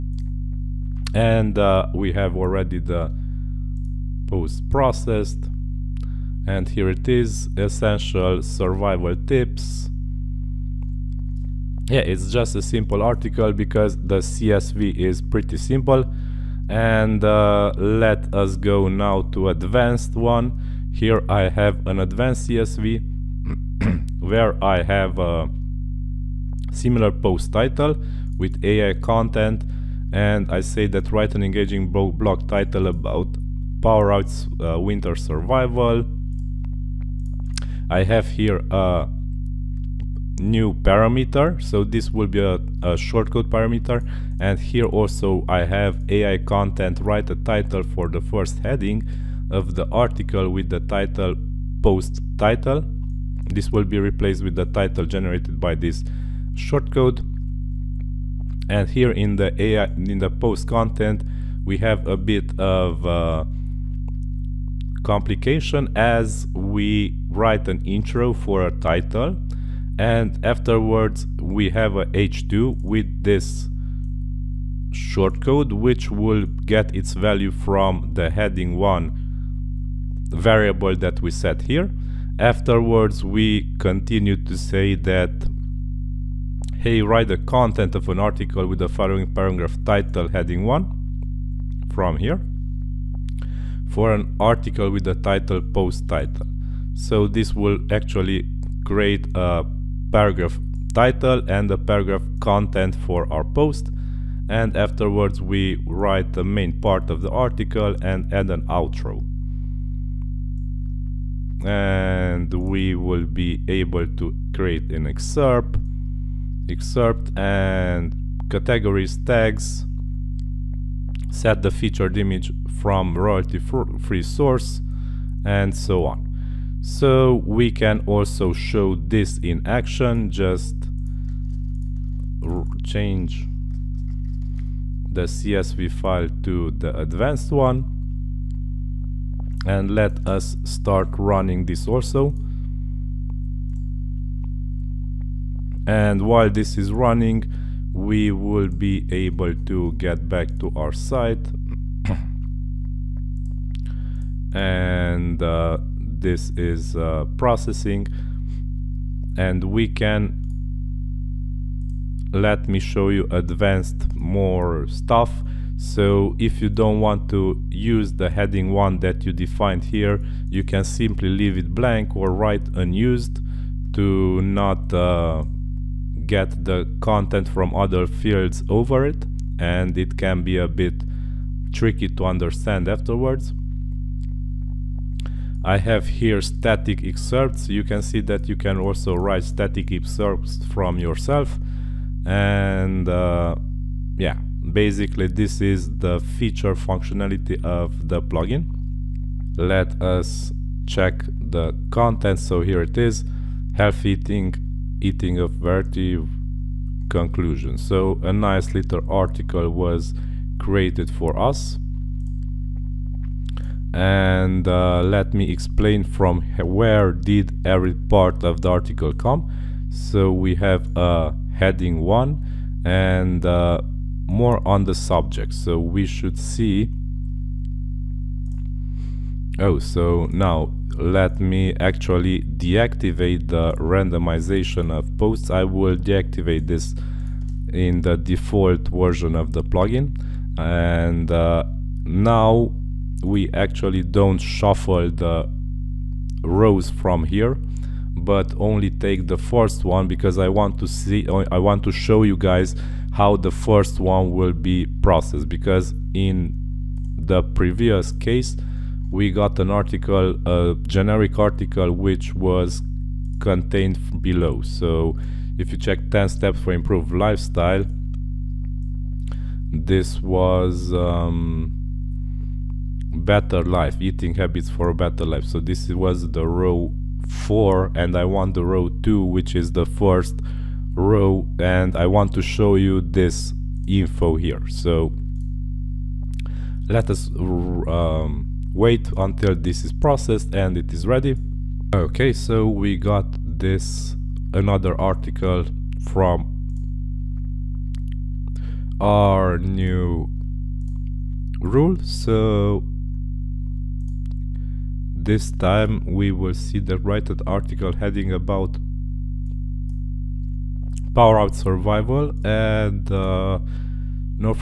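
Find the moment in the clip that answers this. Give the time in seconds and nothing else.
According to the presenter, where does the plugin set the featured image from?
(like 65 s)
123 s.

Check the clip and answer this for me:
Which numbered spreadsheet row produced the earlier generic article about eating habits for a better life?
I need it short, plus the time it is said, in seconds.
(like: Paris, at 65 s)
Row 4, at 276 s.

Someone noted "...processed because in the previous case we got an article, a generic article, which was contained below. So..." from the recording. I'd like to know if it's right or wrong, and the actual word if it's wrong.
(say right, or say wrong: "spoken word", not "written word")
right.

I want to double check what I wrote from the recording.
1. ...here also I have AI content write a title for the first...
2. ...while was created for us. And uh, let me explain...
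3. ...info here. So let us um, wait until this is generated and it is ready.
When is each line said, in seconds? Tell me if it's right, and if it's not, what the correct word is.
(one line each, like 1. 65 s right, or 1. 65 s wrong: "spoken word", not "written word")
1. 44 s right
2. 209 s wrong: "article", not "while"
3. 283 s wrong: "processed", not "generated".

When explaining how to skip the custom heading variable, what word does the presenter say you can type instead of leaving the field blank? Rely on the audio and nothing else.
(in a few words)
unused.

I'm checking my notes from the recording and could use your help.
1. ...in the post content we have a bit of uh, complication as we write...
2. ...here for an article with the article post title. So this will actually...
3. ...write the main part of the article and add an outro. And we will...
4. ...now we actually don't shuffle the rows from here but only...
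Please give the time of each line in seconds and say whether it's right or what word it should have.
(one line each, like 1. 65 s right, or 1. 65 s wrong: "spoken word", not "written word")
1. 59 s right
2. 92 s wrong: "title", not "article"
3. 105 s right
4. 242 s right.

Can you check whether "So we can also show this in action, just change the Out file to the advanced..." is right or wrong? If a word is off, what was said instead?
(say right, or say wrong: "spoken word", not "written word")
wrong: "CSV", not "Out".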